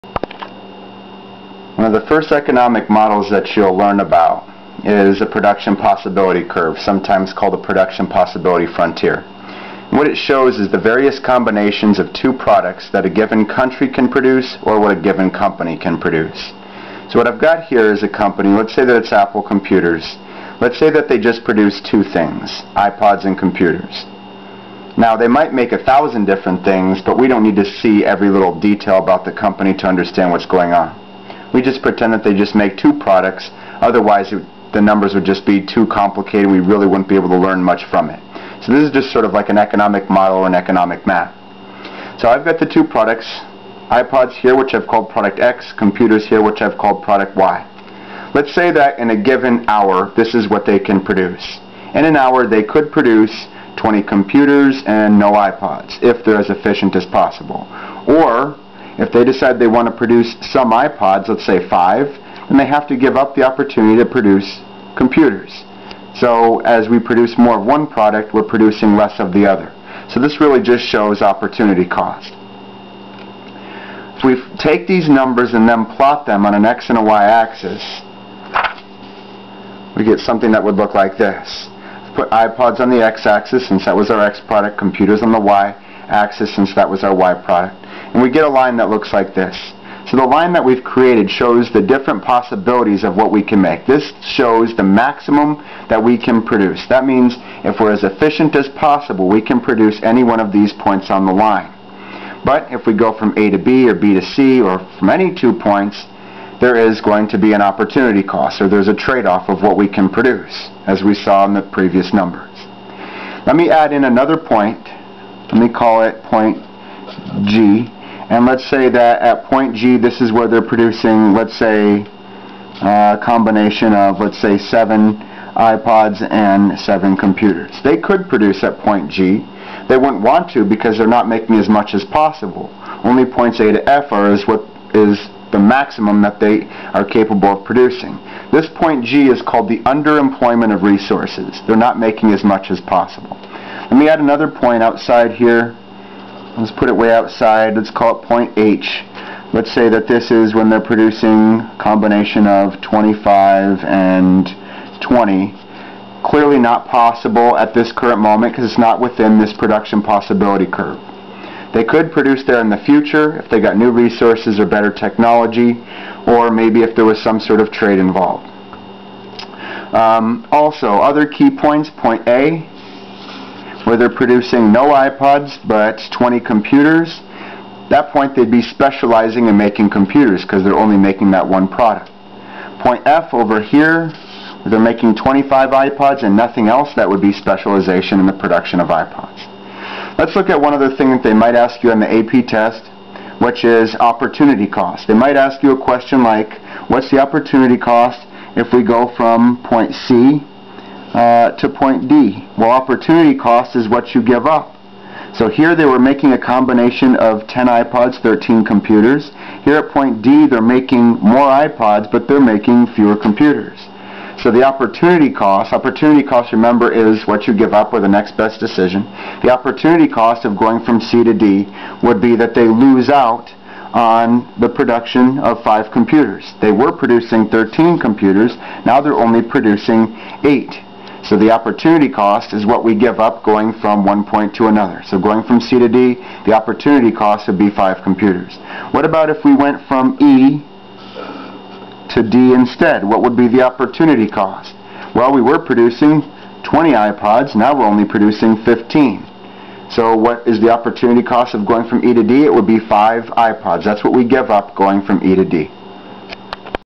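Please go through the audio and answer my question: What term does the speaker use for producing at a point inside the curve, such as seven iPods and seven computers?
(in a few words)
underemployment of resources.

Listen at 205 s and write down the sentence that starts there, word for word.
So here they were making a combination of 10 iPods, 13 computers.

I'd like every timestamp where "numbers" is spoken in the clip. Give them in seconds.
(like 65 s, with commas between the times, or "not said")
34 s, 75 s, 112 s.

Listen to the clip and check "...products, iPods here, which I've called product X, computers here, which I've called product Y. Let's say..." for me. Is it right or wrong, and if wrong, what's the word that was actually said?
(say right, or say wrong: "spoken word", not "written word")
right.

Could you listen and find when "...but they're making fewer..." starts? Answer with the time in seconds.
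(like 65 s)
212 s.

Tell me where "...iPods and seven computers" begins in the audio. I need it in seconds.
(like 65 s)
125 s.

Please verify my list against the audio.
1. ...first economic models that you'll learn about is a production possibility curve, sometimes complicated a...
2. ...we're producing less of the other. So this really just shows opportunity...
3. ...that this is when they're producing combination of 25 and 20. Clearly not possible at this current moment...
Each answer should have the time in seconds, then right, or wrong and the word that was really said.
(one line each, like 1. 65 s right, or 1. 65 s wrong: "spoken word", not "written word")
1. 2 s wrong: "called", not "complicated"
2. 68 s right
3. 149 s right.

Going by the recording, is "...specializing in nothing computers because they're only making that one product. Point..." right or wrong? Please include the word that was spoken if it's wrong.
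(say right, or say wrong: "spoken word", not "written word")
wrong: "making", not "nothing".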